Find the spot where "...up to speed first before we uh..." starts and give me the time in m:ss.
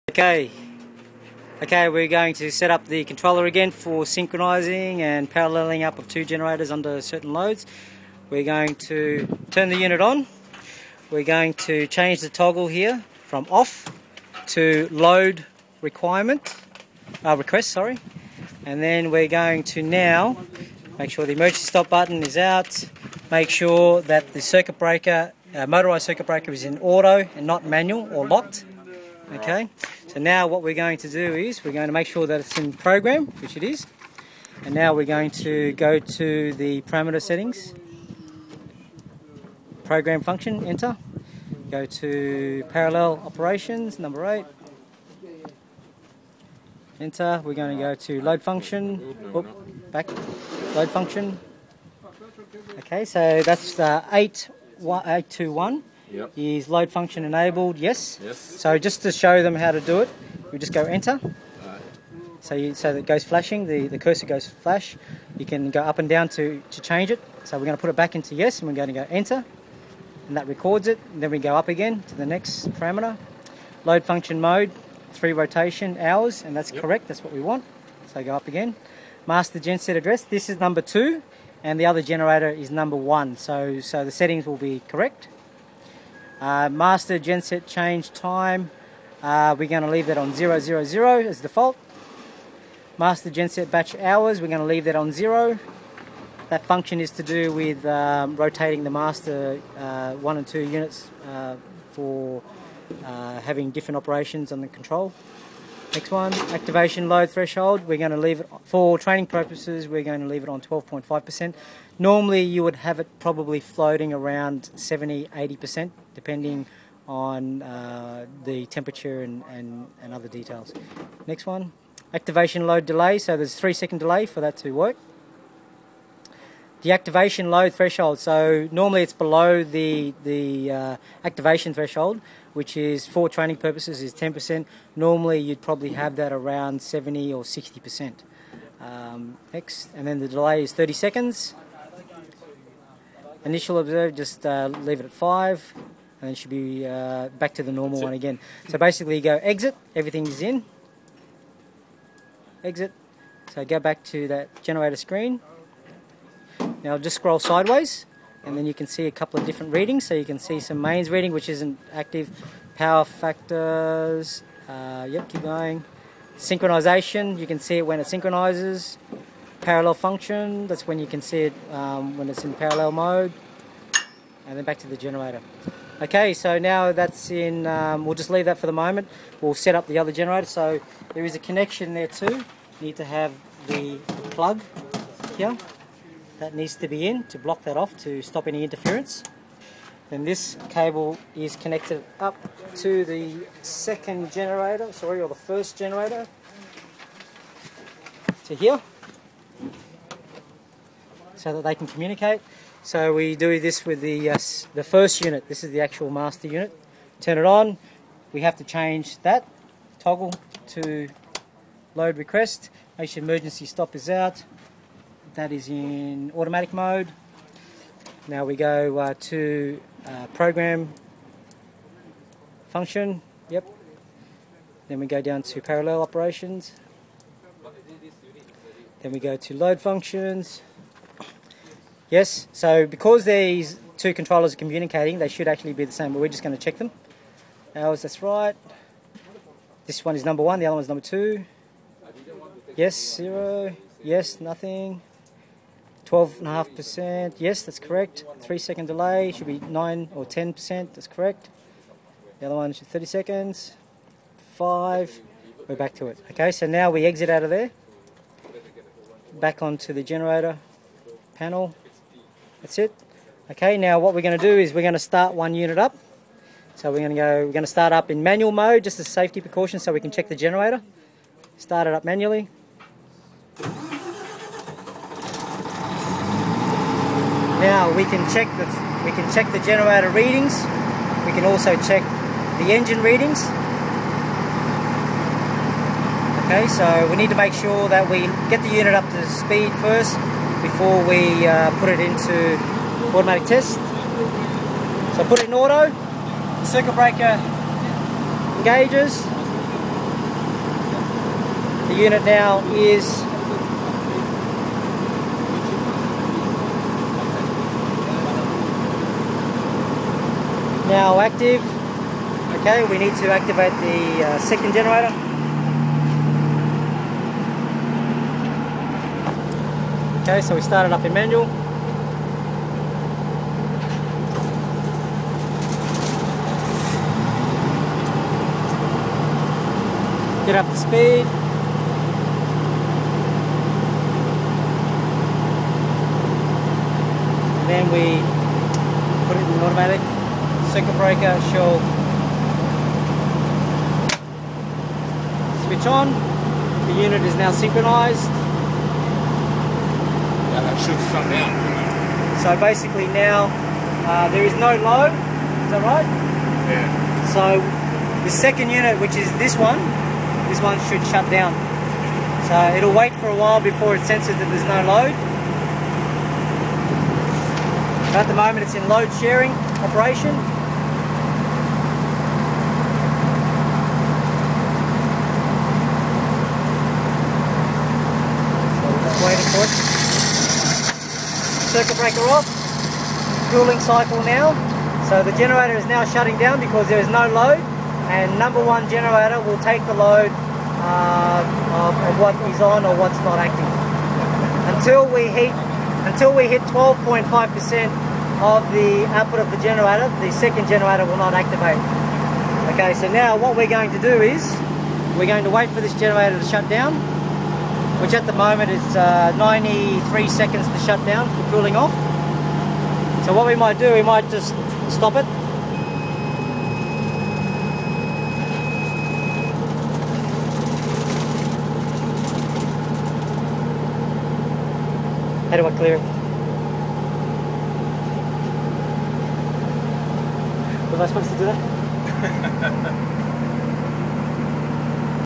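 4:48.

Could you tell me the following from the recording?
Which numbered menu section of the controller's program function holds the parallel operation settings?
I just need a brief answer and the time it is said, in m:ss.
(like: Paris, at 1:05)
8, at 0:43.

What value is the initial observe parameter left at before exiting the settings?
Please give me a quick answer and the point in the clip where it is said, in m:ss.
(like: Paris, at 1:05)
5, at 2:25.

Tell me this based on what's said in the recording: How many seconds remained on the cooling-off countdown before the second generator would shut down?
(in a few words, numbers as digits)
93.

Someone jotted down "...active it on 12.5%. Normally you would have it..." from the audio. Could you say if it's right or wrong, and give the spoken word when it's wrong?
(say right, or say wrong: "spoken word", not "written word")
wrong: "leave", not "active".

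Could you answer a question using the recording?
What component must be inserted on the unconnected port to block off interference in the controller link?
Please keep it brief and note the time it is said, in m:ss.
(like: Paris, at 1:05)
The plug, at 3:04.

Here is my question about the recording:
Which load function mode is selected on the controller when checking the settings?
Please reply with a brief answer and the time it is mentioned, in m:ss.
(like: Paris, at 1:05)
Rotation hours, at 1:15.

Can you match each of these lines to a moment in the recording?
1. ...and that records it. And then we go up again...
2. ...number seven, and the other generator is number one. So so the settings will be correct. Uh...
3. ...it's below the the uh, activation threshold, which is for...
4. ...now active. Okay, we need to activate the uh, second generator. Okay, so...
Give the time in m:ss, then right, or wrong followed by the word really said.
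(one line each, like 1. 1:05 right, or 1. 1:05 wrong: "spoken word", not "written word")
1. 1:10 right
2. 1:20 wrong: "two", not "seven"
3. 2:09 right
4. 5:10 right.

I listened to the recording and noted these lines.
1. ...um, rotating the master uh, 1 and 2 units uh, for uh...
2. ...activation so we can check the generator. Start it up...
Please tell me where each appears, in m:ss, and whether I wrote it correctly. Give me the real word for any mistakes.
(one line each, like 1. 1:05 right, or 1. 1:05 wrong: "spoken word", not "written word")
1. 1:37 right
2. 4:29 wrong: "precaution", not "activation".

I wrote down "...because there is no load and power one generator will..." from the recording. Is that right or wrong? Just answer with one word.
wrong.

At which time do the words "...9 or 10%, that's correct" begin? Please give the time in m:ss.
4:09.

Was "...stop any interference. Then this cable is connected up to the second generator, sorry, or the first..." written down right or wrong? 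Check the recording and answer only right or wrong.
right.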